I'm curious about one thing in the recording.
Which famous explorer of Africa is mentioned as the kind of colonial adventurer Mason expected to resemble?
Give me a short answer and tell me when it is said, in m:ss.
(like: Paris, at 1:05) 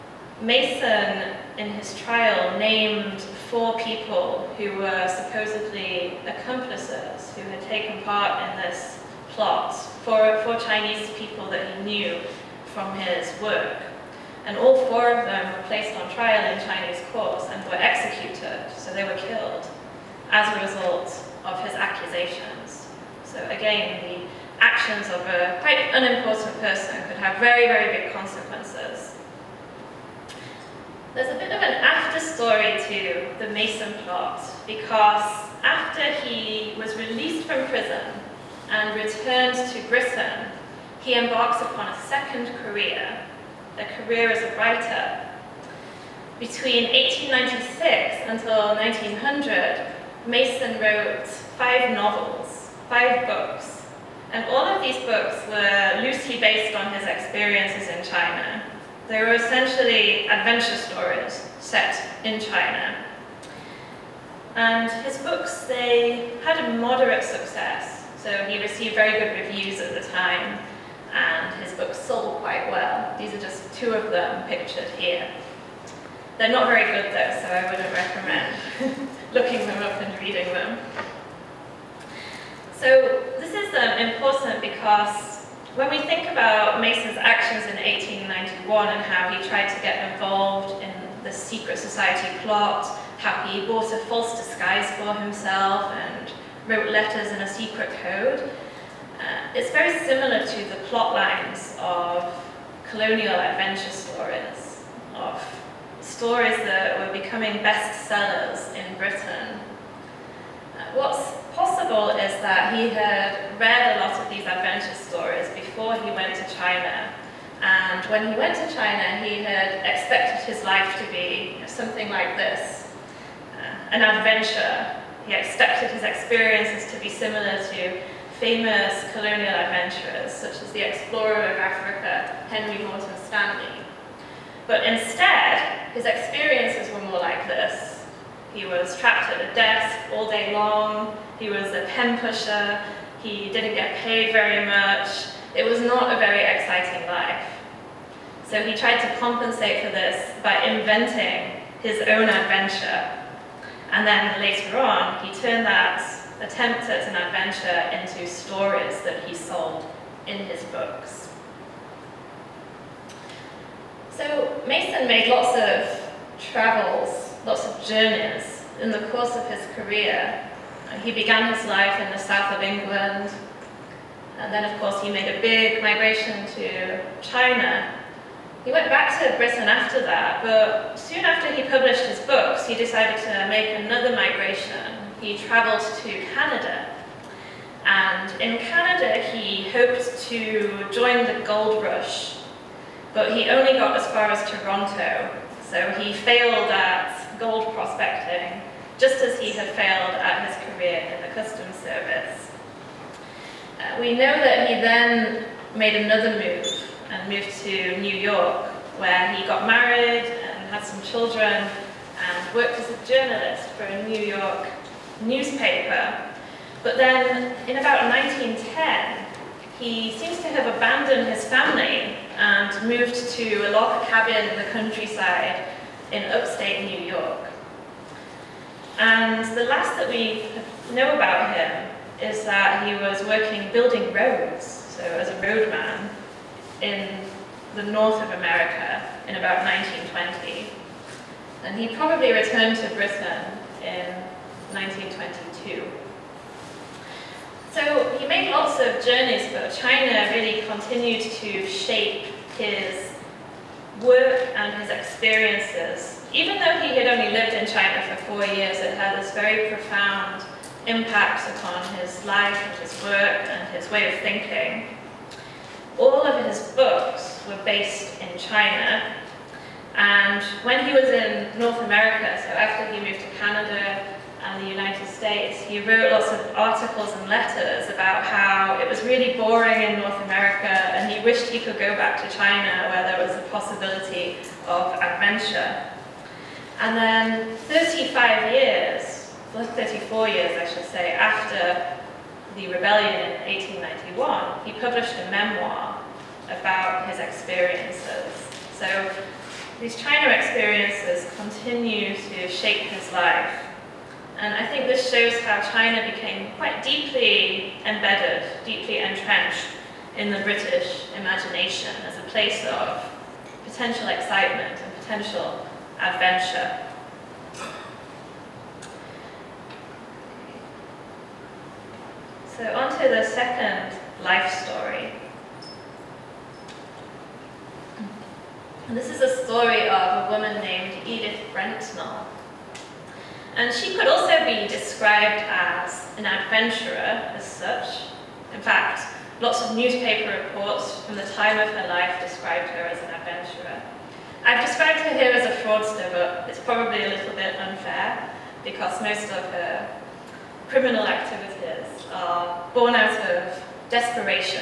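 Henry Morton Stanley, at 2:12.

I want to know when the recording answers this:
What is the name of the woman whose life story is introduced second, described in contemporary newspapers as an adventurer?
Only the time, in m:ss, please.
5:31.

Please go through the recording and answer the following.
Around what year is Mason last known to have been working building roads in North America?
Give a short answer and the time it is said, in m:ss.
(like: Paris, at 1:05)
1920, at 3:59.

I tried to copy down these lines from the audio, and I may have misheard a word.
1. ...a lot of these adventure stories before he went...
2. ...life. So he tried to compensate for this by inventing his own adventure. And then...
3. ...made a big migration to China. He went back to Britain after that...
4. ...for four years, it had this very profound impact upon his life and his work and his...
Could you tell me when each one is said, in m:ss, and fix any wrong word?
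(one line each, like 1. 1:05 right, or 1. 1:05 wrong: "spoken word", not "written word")
1. 1:53 right
2. 2:27 right
3. 2:55 right
4. 4:18 right.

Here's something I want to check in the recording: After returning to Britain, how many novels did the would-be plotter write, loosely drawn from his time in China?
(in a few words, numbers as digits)
5.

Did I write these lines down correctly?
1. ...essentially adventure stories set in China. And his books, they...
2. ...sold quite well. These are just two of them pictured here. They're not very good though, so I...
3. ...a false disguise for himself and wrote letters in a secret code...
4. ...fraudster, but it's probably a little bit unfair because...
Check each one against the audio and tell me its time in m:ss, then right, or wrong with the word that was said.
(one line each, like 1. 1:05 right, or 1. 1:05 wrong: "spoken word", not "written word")
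1. 0:59 right
2. 1:11 right
3. 1:33 right
4. 5:45 right.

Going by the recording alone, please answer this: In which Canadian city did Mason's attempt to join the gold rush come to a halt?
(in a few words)
Toronto.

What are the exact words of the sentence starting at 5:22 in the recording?
So on to the second life story.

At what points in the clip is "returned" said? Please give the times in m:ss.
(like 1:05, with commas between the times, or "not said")
0:38, 4:02.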